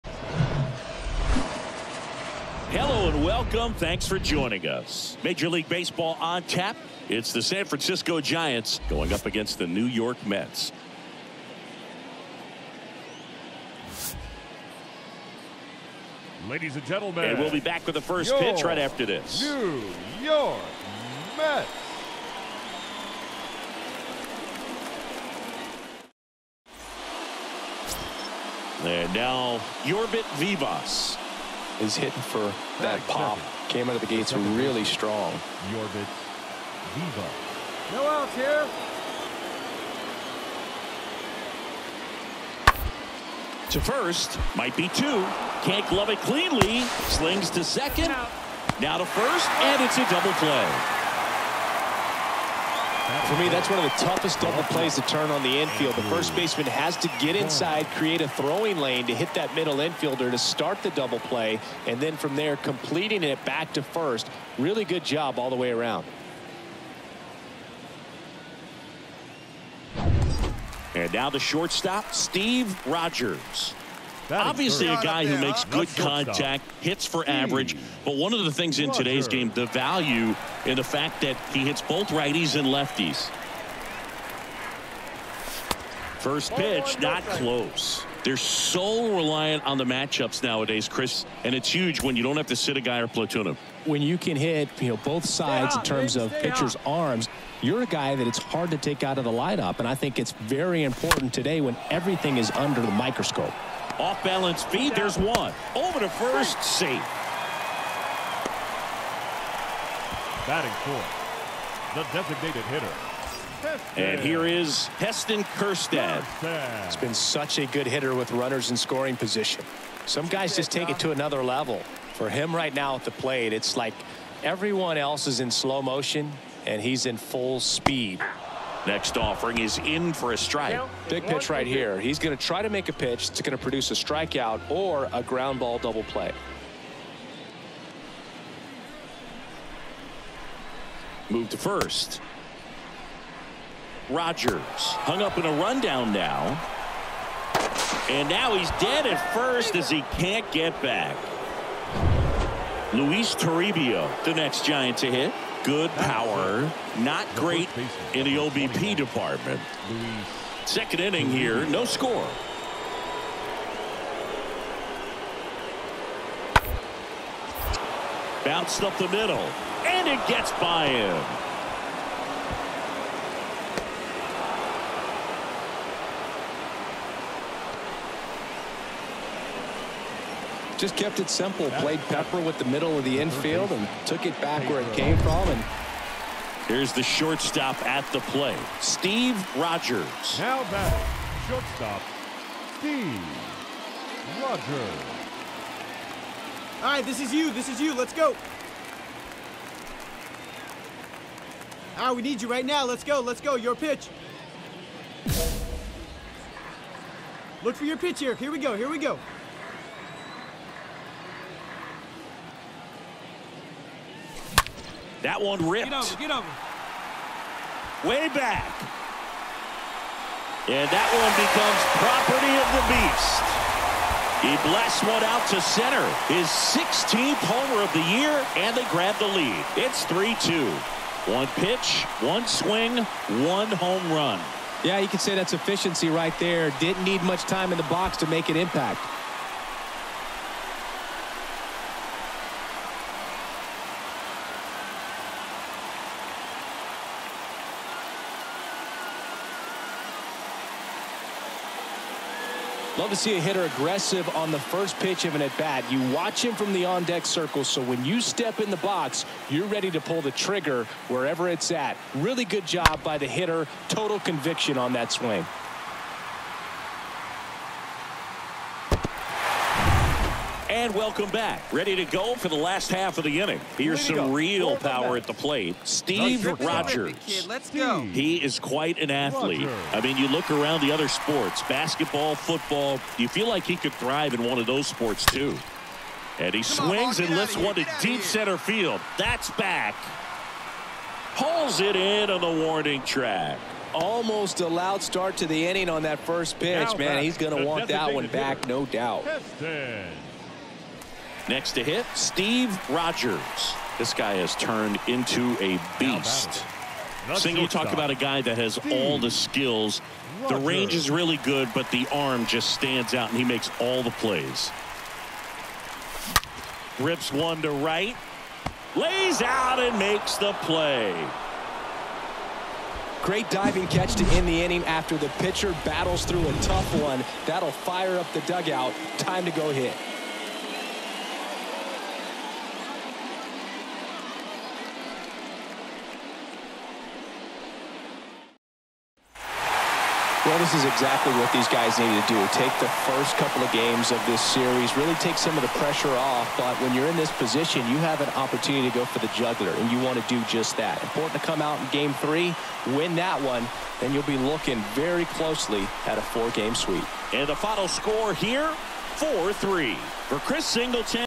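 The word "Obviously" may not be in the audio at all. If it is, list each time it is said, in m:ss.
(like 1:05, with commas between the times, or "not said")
1:14.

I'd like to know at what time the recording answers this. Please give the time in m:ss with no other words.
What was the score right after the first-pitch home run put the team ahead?
3:50.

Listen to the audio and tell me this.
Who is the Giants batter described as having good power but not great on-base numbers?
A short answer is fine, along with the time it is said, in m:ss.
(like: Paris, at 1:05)
Luis Toribio, at 2:32.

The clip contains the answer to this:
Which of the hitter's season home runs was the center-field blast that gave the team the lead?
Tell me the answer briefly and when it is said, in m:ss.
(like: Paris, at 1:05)
16th, at 3:46.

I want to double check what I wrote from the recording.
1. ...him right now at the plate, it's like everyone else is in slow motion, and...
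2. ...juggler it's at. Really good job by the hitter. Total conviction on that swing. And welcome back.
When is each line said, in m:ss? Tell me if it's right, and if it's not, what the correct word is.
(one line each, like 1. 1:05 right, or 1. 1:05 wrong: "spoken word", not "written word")
1. 2:02 right
2. 4:21 wrong: "wherever", not "juggler".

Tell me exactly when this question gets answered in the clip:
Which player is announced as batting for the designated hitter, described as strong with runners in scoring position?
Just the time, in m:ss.
1:54.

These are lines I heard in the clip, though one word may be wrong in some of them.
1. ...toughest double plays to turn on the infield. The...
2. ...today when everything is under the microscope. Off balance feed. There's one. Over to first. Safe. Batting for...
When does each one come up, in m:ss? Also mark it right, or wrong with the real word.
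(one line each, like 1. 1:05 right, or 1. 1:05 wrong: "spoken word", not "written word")
1. 0:54 right
2. 1:41 right.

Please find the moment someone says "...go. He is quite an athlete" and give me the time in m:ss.
4:37.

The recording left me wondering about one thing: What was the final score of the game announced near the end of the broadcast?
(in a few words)
4-3.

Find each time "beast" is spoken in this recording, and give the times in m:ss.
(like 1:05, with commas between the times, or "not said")
3:42, 5:05.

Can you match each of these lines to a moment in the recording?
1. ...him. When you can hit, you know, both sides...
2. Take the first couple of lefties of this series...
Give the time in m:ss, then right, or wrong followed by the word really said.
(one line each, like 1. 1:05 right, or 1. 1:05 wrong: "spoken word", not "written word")
1. 1:33 right
2. 5:42 wrong: "games", not "lefties".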